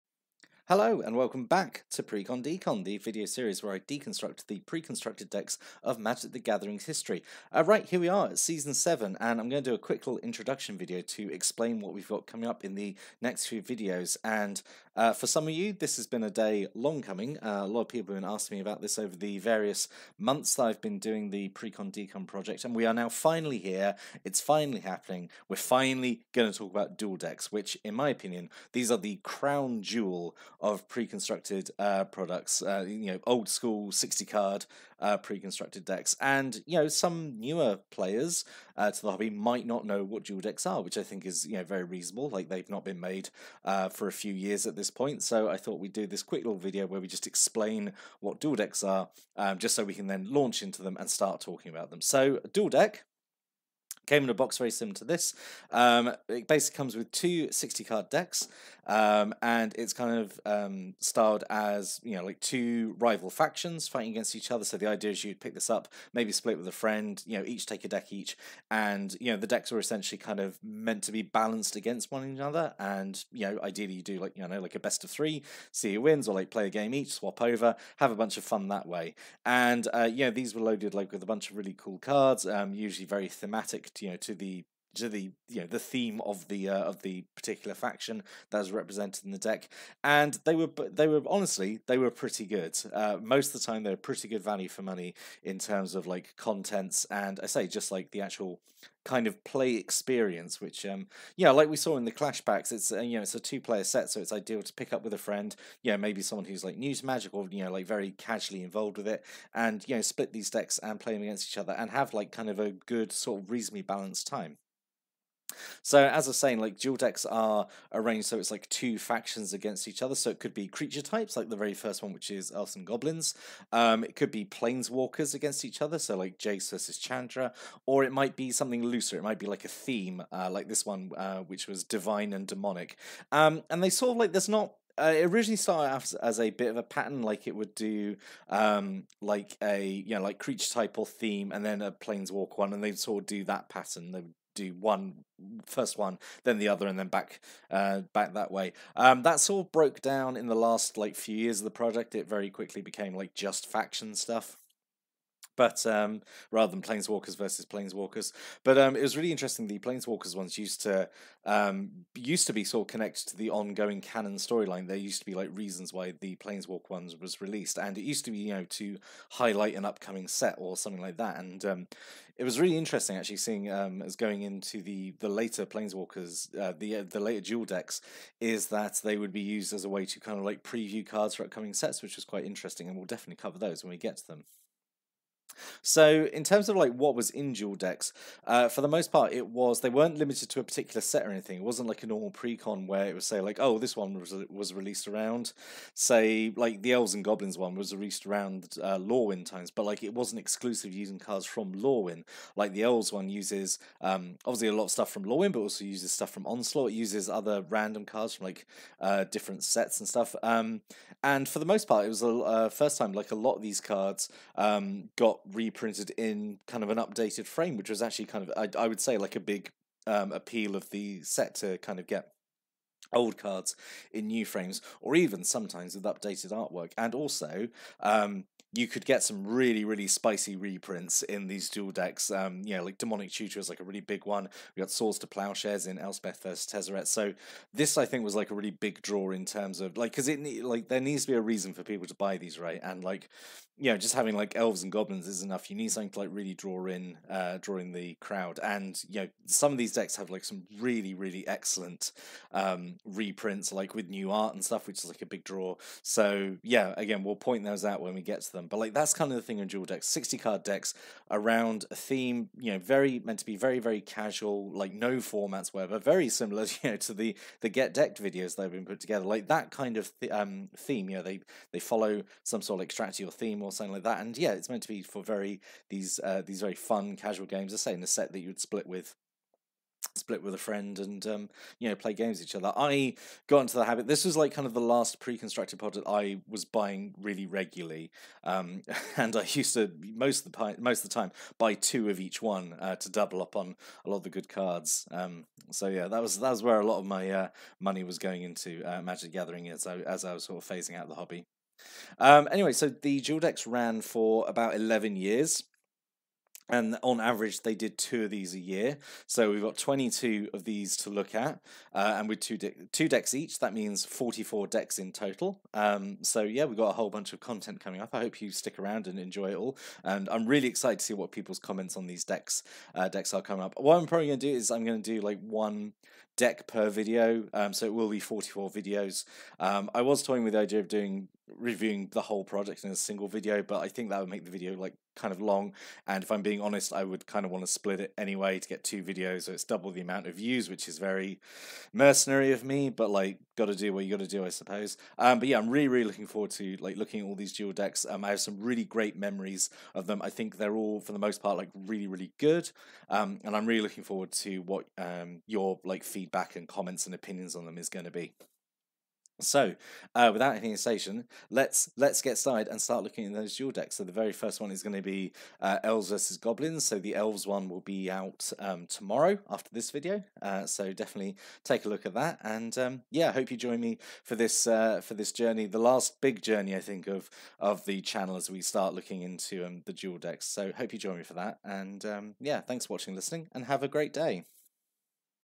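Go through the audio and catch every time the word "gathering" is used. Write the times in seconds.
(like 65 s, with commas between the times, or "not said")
6 s, 299 s.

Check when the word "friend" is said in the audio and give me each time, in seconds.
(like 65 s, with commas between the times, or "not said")
66 s, 105 s, 280 s.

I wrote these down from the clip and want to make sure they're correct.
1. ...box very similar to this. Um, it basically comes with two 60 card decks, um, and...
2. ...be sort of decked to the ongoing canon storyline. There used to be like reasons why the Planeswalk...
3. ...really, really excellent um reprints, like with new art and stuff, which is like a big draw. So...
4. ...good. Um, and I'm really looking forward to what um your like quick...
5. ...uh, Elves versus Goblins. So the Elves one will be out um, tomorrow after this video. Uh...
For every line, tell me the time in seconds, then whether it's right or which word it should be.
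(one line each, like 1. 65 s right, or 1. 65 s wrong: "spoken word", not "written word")
1. 54 s right
2. 162 s wrong: "connected", not "decked"
3. 250 s right
4. 352 s wrong: "feedback", not "quick"
5. 365 s right.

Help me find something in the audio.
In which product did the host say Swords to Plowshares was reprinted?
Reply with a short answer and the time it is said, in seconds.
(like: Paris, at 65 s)
Elspeth versus Tezzeret, at 235 s.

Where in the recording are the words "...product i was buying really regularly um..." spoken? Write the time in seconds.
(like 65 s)
285 s.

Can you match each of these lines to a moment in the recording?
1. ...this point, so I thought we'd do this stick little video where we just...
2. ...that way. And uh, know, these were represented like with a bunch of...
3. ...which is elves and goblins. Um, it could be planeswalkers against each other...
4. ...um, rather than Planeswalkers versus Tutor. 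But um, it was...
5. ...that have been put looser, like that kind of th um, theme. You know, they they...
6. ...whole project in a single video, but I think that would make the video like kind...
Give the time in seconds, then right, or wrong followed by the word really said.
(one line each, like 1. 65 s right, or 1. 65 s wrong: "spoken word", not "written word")
1. 44 s wrong: "quick", not "stick"
2. 78 s wrong: "loaded", not "represented"
3. 122 s right
4. 155 s wrong: "Planeswalkers", not "Tutor"
5. 268 s wrong: "together", not "looser"
6. 332 s right.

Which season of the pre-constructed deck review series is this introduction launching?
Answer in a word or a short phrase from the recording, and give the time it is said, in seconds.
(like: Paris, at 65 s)
Season 7, at 8 s.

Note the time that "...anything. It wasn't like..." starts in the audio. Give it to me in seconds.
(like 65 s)
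191 s.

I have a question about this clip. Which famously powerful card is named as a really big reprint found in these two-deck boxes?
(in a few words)
Demonic Tutor.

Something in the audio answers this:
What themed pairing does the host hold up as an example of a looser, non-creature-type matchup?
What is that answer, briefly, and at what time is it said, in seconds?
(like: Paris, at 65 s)
Divine and Demonic, at 131 s.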